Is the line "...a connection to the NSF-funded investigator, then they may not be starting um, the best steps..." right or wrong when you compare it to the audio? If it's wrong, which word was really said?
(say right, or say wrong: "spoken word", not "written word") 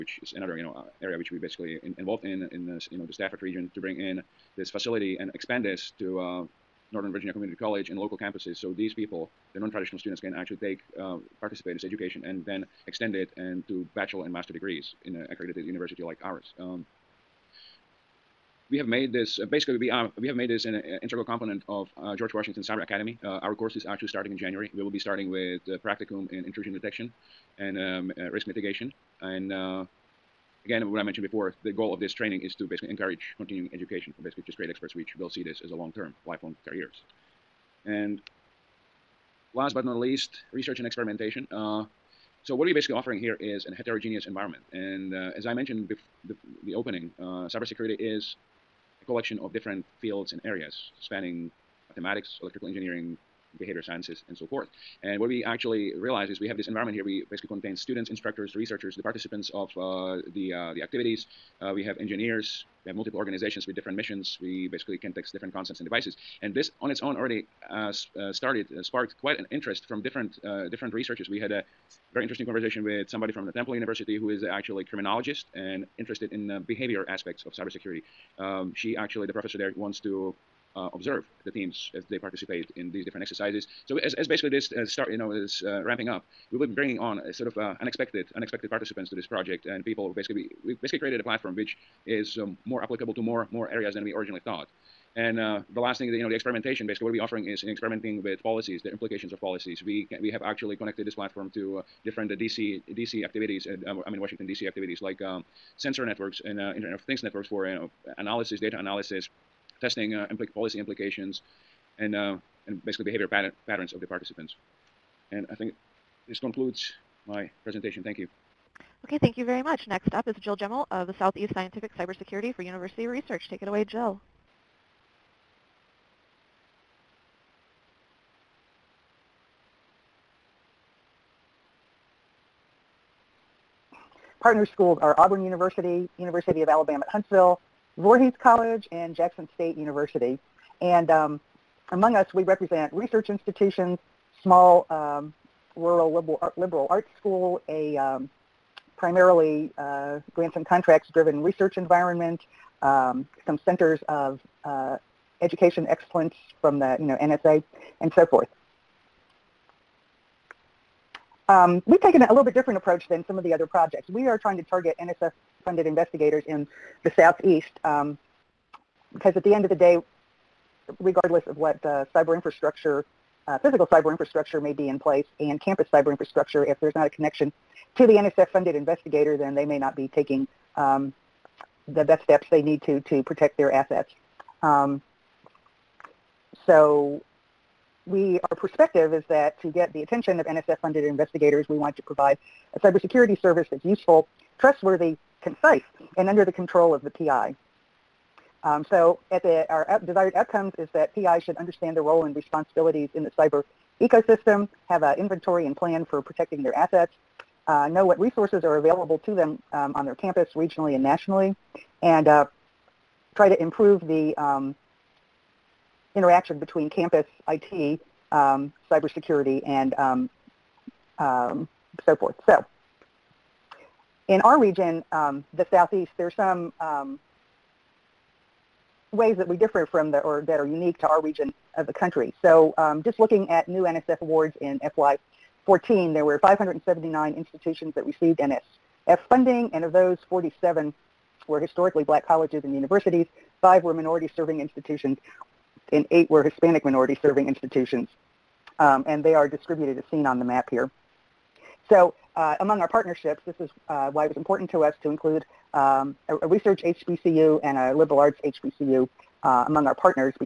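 wrong: "taking", not "starting".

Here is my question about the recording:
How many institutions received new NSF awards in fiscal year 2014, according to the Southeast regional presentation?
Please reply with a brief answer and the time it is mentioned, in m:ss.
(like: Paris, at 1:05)
579, at 3:56.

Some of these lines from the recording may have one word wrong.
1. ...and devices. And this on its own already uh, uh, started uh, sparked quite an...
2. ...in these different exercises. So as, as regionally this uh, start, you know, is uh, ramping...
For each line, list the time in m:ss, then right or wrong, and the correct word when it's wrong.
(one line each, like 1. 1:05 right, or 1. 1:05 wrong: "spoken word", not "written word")
1. 1:05 right
2. 1:22 wrong: "basically", not "regionally".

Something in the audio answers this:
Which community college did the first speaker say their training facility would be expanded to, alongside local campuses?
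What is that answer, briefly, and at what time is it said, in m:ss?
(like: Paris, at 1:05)
Northern Virginia Community College, at 0:06.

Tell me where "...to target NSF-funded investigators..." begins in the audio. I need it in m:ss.
2:44.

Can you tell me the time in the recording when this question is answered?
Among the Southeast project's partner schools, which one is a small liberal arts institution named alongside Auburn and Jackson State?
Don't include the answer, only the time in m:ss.
2:17.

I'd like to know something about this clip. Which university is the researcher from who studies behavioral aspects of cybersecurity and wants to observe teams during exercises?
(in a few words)
Temple University.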